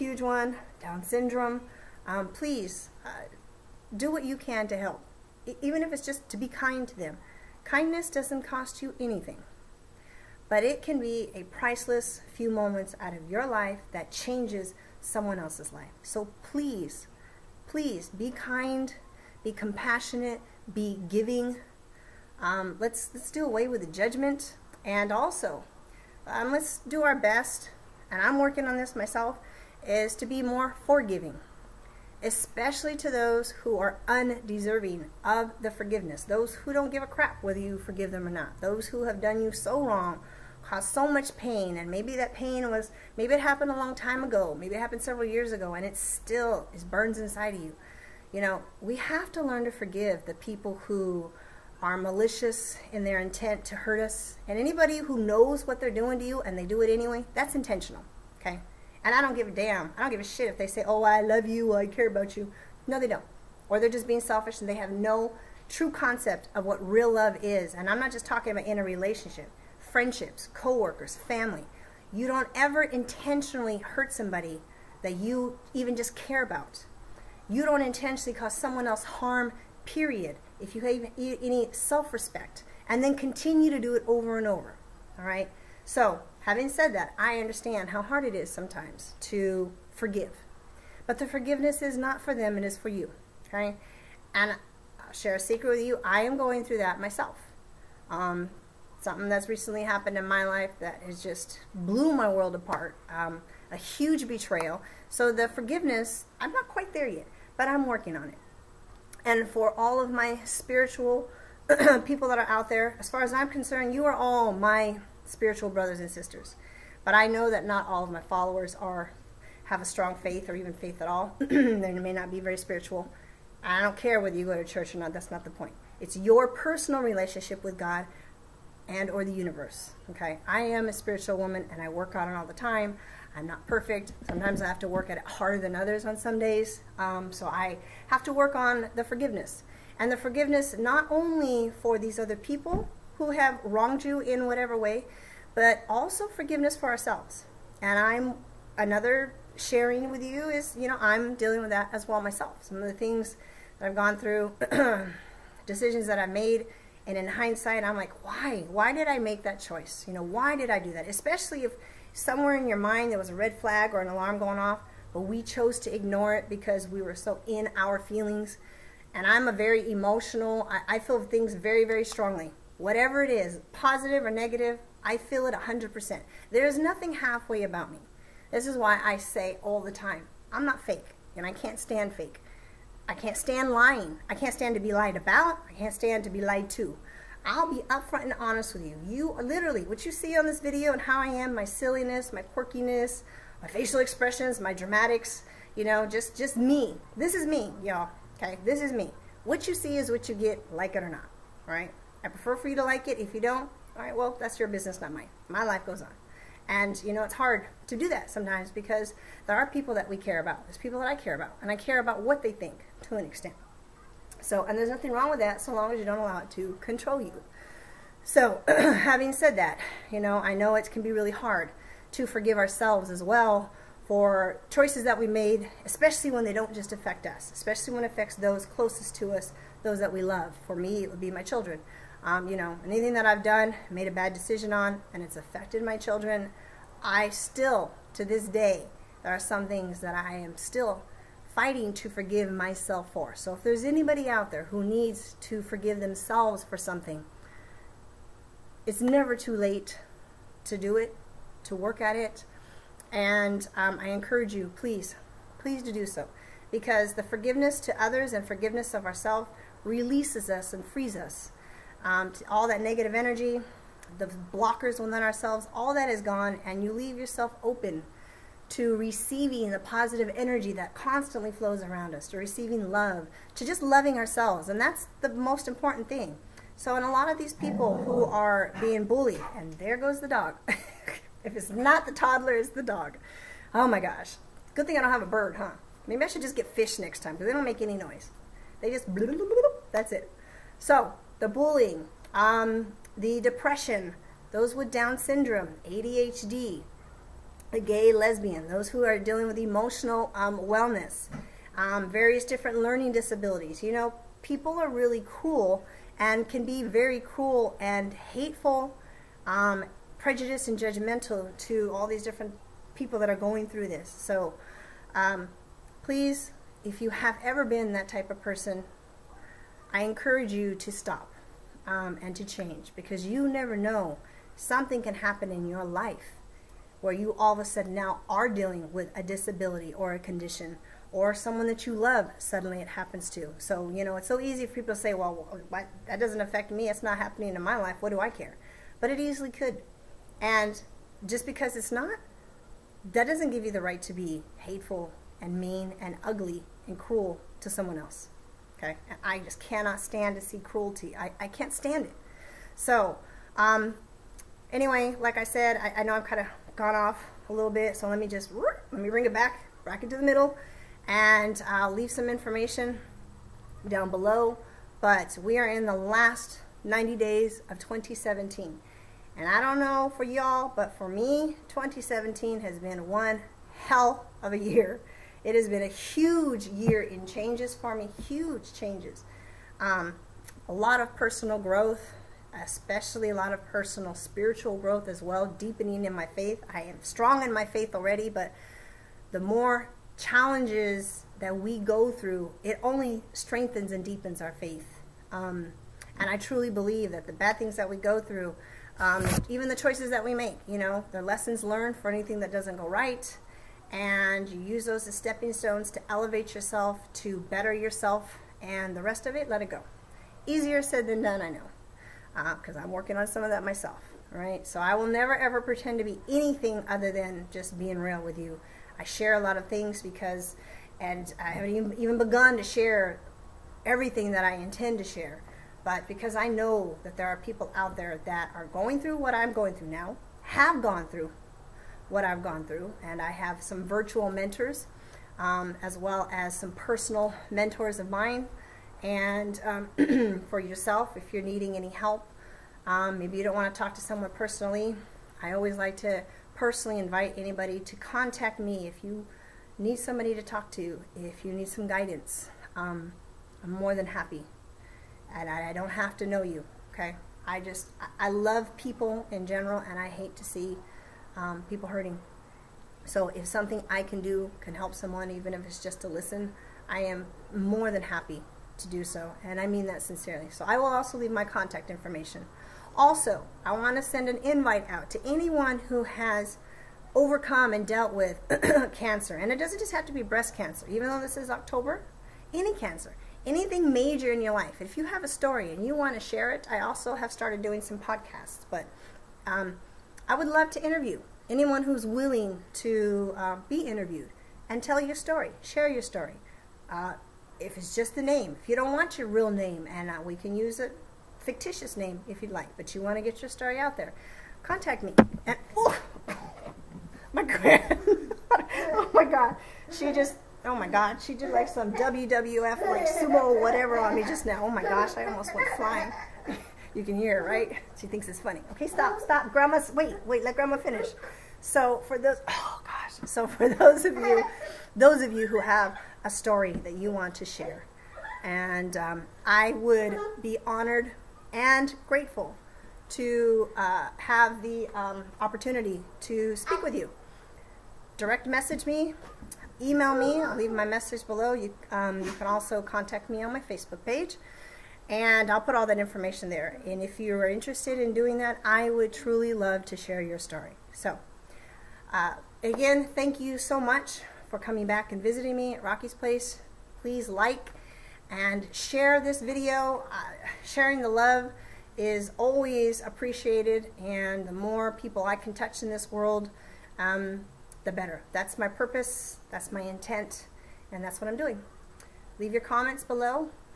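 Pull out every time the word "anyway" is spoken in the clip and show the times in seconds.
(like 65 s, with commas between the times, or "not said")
56 s, 354 s.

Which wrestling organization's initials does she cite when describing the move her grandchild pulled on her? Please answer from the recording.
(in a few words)
WWF.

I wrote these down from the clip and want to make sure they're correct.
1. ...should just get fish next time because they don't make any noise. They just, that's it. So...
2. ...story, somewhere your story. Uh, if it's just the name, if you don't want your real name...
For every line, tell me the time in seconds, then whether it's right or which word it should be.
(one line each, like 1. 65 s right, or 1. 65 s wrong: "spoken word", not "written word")
1. 286 s right
2. 495 s wrong: "share", not "somewhere".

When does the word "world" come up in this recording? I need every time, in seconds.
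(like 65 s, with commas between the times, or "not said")
102 s, 566 s.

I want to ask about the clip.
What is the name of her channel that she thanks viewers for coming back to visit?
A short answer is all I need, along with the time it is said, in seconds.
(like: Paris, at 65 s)
Rockie's Place, at 555 s.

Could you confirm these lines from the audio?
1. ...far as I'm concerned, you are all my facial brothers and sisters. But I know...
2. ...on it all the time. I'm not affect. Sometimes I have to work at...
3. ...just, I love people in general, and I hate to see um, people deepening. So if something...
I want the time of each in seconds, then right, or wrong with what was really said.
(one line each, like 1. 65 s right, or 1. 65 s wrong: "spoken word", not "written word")
1. 113 s wrong: "spiritual", not "facial"
2. 132 s wrong: "perfect", not "affect"
3. 457 s wrong: "hurting", not "deepening".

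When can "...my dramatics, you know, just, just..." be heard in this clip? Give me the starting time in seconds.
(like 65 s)
194 s.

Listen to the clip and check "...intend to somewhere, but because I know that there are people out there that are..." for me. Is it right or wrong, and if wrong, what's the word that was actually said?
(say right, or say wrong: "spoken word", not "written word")
wrong: "share", not "somewhere".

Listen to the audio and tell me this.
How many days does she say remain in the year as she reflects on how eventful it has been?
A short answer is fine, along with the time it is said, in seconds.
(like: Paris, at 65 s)
90, at 366 s.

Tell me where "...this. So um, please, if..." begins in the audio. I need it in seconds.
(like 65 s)
313 s.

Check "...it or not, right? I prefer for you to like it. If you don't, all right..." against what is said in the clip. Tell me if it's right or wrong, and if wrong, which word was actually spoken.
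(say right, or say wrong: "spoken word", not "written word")
right.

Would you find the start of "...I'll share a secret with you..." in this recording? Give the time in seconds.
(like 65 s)
94 s.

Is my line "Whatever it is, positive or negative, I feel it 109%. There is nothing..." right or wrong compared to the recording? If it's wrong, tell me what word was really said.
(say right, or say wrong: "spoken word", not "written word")
wrong: "100", not "109".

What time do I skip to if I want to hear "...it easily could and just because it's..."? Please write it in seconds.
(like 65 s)
339 s.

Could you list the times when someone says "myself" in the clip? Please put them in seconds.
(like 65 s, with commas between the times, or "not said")
28 s, 97 s, 152 s, 242 s, 413 s.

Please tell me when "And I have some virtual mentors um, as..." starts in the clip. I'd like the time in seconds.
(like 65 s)
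433 s.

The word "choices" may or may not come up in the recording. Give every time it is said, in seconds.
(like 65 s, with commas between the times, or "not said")
159 s, 224 s, 399 s.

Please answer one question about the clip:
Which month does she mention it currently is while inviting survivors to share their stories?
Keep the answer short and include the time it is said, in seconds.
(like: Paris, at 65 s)
October, at 481 s.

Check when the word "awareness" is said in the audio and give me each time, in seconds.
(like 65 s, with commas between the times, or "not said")
not said.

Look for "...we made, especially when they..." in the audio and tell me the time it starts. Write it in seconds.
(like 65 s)
225 s.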